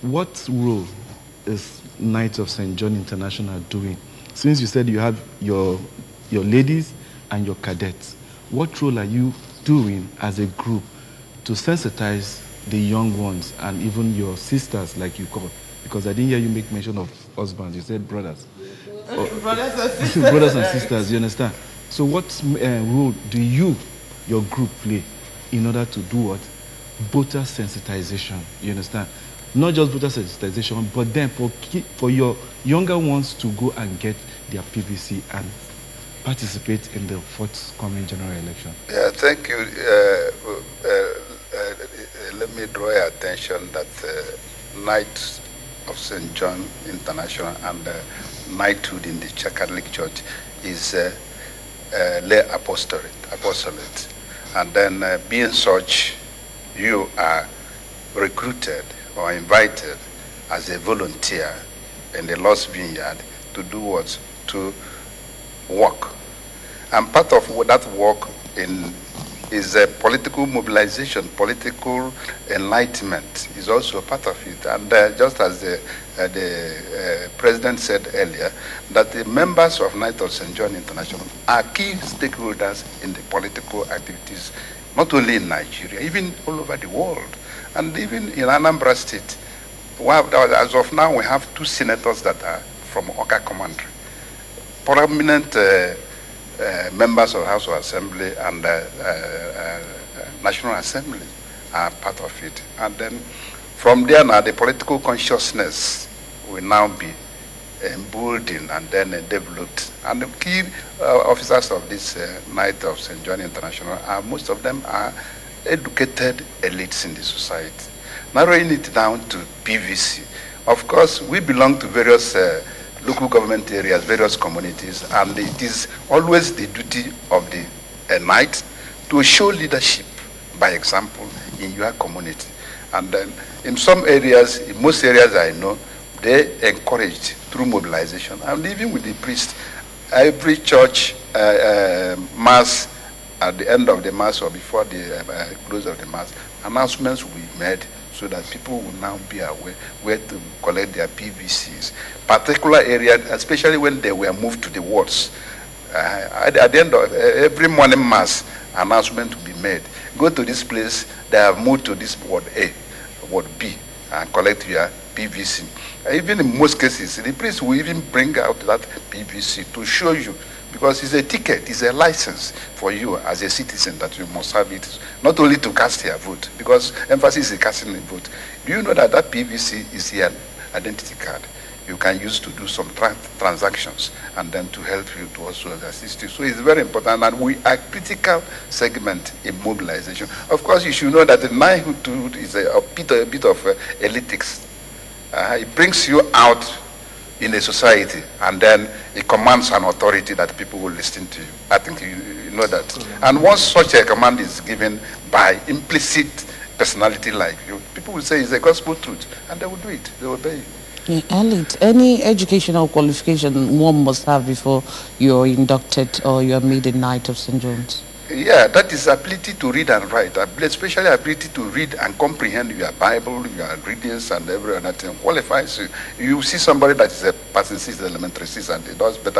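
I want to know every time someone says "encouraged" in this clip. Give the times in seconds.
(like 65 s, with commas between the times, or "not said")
136 s.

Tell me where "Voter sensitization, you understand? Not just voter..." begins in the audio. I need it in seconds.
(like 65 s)
27 s.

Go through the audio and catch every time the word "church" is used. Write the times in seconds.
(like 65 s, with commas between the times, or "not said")
49 s, 140 s.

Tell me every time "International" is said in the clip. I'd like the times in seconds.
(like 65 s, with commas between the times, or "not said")
2 s, 46 s, 80 s, 113 s.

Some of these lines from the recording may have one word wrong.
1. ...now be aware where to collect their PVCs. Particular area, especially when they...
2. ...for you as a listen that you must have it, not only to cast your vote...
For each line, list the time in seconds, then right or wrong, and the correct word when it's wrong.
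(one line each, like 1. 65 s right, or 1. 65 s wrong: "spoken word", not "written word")
1. 148 s right
2. 172 s wrong: "citizen", not "listen".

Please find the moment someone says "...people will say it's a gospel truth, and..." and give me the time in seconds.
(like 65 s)
207 s.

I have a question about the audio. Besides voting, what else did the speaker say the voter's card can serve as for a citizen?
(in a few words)
Identity card.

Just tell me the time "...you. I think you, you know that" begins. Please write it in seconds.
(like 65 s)
201 s.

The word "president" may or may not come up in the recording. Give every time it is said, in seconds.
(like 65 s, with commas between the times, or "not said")
77 s.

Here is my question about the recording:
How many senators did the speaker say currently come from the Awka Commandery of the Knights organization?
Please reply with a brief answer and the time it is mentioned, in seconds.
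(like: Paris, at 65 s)
2, at 91 s.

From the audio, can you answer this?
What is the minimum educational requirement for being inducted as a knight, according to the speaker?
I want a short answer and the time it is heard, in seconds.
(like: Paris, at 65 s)
Ability to read and write, at 219 s.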